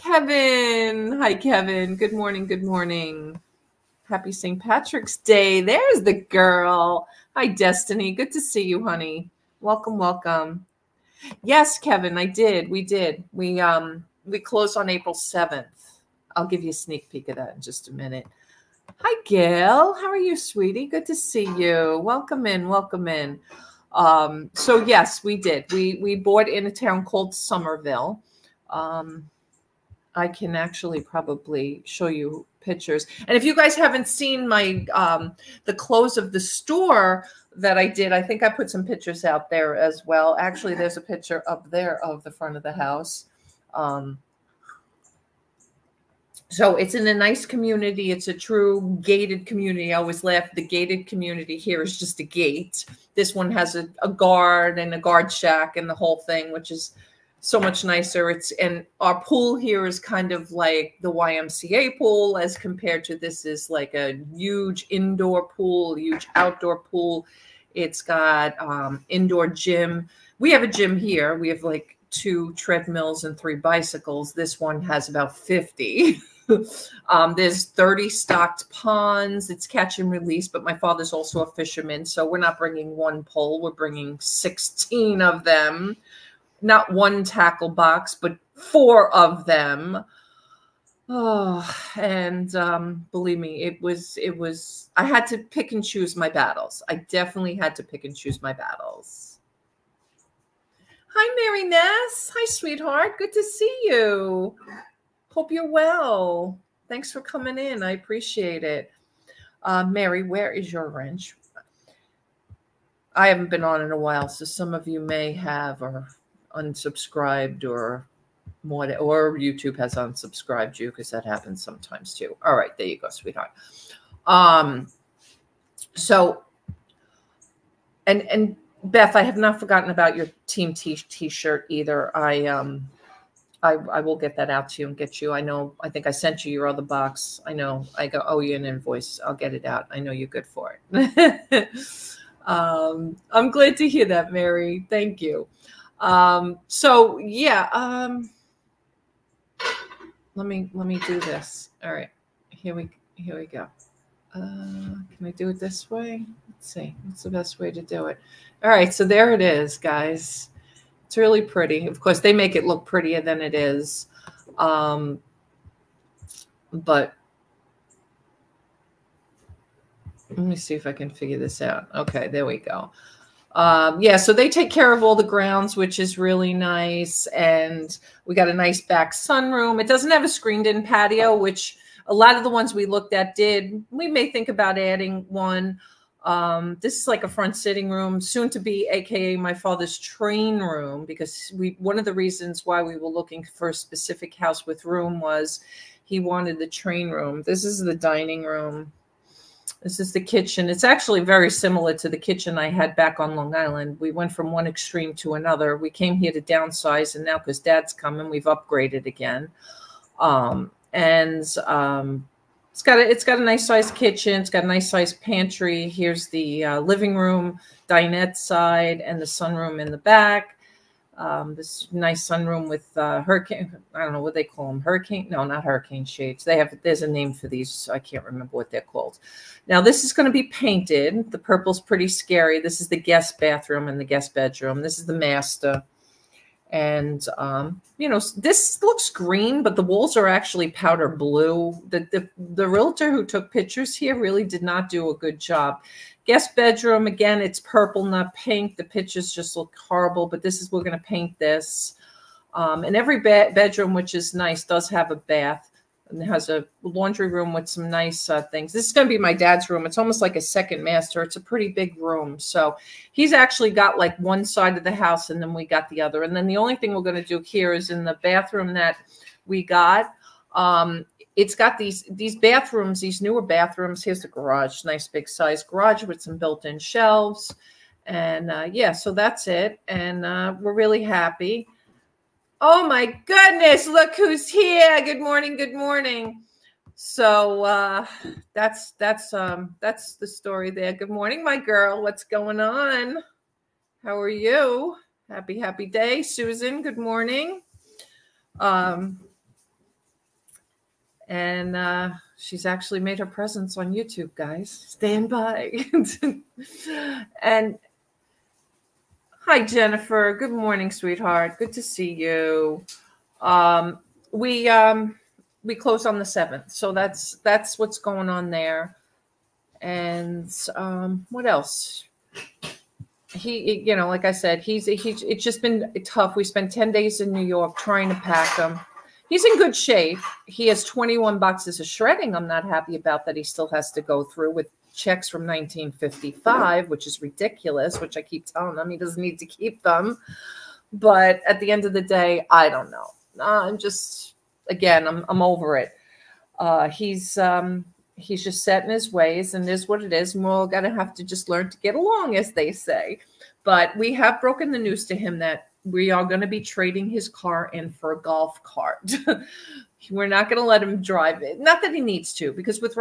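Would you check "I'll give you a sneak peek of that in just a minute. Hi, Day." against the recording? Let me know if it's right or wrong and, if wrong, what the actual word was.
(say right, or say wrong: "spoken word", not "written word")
wrong: "Gail", not "Day".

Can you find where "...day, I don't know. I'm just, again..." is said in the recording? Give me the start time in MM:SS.
05:42.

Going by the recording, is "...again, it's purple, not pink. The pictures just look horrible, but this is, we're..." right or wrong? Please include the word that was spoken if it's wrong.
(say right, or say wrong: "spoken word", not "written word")
right.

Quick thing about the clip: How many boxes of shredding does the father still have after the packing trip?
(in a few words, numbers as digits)
21.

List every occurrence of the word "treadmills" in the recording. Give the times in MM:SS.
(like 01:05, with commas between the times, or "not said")
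01:12.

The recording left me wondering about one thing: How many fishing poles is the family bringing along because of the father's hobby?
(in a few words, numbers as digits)
16.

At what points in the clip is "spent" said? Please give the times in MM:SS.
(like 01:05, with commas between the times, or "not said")
05:26.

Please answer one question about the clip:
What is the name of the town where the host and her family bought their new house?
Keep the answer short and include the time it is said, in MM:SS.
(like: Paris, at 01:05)
Summerville, at 00:27.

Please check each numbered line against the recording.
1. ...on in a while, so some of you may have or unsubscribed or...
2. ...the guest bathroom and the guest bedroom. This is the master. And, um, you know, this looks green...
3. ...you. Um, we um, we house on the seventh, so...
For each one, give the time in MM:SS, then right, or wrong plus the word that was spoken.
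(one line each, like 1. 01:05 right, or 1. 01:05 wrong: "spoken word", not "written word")
1. 01:53 right
2. 03:52 right
3. 05:12 wrong: "close", not "house".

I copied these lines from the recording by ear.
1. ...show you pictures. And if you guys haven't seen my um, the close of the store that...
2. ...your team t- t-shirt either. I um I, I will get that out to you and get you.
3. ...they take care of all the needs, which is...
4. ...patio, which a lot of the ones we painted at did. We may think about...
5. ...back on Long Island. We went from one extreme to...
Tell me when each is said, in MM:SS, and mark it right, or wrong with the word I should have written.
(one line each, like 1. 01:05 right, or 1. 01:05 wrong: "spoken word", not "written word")
1. 00:31 right
2. 02:10 right
3. 02:54 wrong: "grounds", not "needs"
4. 03:00 wrong: "looked", not "painted"
5. 03:22 right.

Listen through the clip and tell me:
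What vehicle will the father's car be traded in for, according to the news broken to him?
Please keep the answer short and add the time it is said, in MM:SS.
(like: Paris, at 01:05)
golf cart, at 05:58.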